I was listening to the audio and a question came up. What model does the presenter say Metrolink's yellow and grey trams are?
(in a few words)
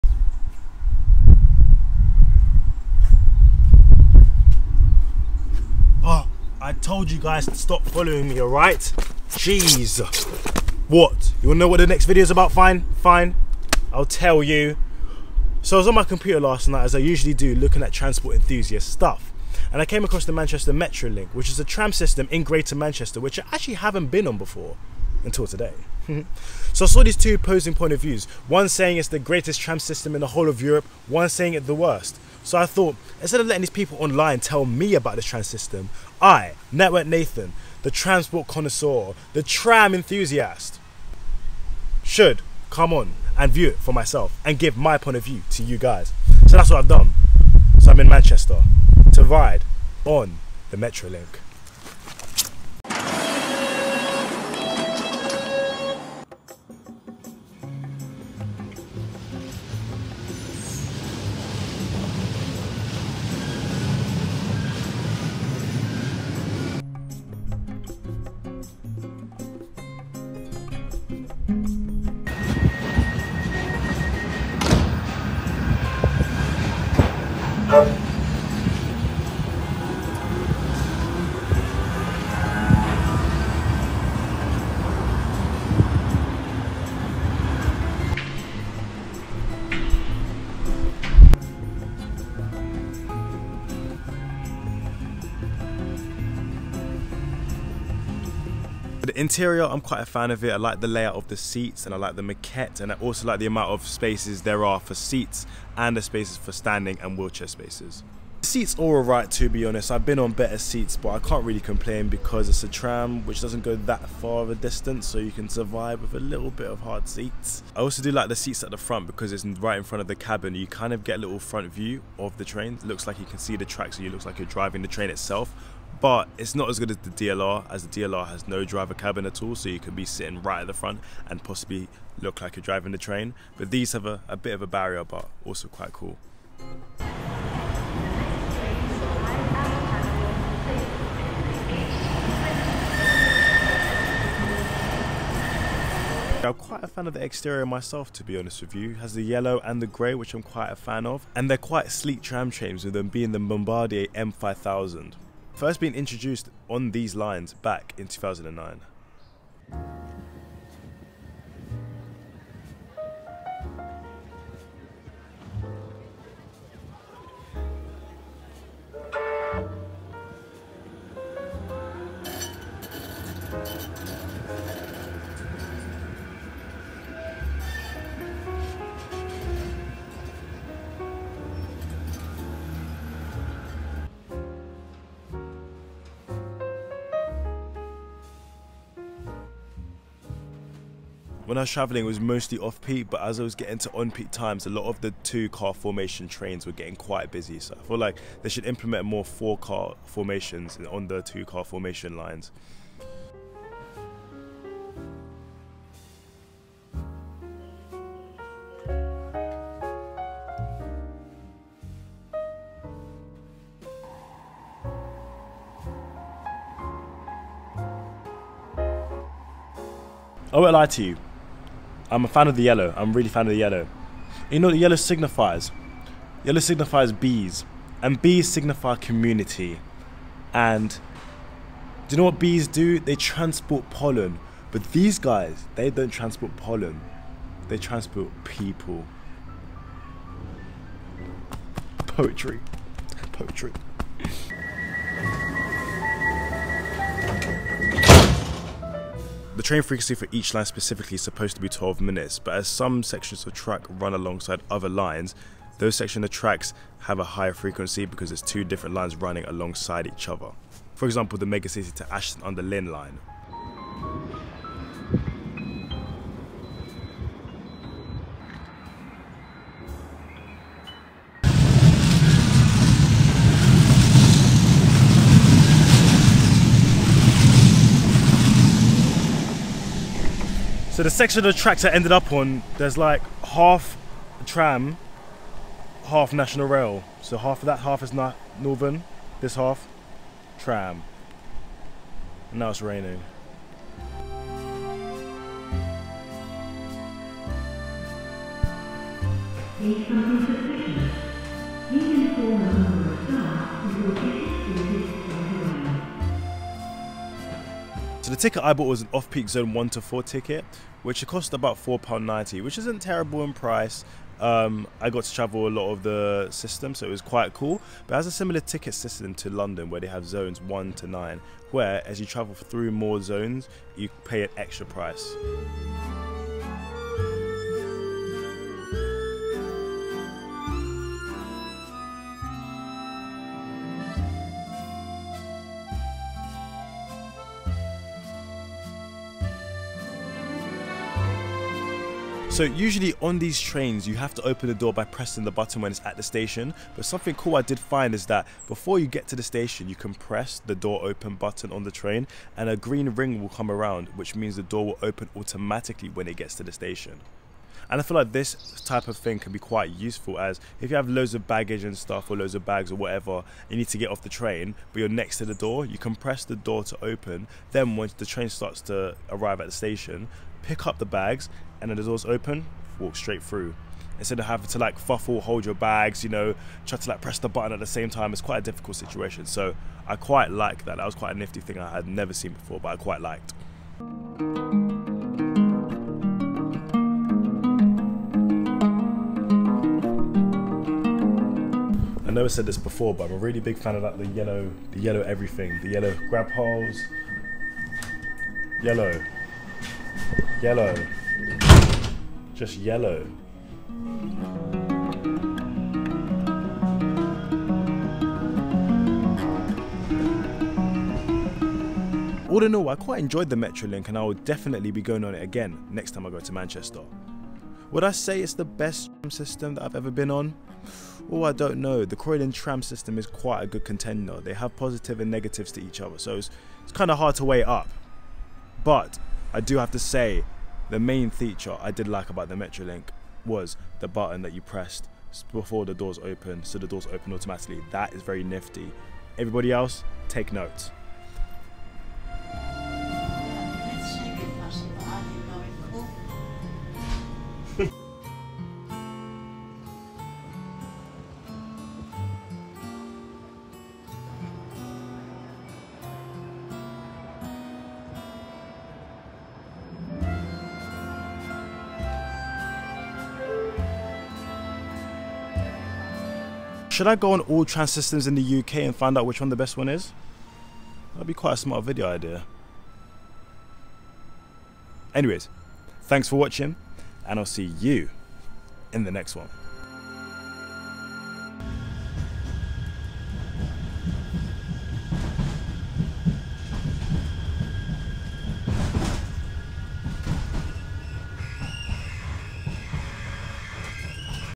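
Bombardier M5000.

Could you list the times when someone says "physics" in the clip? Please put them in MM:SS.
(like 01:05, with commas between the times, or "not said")
not said.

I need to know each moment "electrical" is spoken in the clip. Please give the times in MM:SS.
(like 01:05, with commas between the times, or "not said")
not said.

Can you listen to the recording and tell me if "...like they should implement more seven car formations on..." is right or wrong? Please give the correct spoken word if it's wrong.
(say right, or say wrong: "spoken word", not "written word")
wrong: "four", not "seven".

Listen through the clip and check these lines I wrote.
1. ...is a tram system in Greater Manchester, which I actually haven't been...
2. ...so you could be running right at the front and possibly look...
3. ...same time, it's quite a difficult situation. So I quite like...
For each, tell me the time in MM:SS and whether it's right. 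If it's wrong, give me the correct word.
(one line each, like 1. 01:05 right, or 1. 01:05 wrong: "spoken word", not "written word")
1. 00:21 right
2. 02:09 wrong: "sitting", not "running"
3. 06:17 right.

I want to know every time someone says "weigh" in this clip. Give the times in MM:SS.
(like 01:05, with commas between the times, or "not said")
07:07.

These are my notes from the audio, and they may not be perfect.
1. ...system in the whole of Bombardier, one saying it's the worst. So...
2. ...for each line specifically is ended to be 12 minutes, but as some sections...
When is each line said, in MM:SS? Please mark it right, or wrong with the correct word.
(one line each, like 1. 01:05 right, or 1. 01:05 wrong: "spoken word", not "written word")
1. 00:29 wrong: "Europe", not "Bombardier"
2. 04:10 wrong: "supposed", not "ended".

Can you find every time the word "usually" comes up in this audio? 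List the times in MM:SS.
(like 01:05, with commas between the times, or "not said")
00:16, 05:42.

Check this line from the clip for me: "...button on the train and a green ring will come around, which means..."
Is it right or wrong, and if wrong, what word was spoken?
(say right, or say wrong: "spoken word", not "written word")
right.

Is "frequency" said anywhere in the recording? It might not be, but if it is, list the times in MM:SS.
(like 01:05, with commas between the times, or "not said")
04:09, 04:17.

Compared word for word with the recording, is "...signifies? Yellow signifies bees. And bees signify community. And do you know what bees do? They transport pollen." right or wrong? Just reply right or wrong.
right.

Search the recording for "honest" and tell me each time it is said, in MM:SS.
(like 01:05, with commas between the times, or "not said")
01:49, 02:28.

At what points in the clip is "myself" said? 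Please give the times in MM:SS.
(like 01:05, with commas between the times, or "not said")
00:43, 02:27.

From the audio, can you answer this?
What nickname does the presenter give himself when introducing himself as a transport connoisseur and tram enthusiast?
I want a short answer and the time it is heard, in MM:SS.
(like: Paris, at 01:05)
Network Nathan, at 00:36.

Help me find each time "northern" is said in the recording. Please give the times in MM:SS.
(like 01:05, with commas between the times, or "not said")
04:48.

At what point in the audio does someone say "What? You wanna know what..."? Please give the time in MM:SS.
00:10.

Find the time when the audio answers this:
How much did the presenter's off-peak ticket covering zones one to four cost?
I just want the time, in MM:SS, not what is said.
05:11.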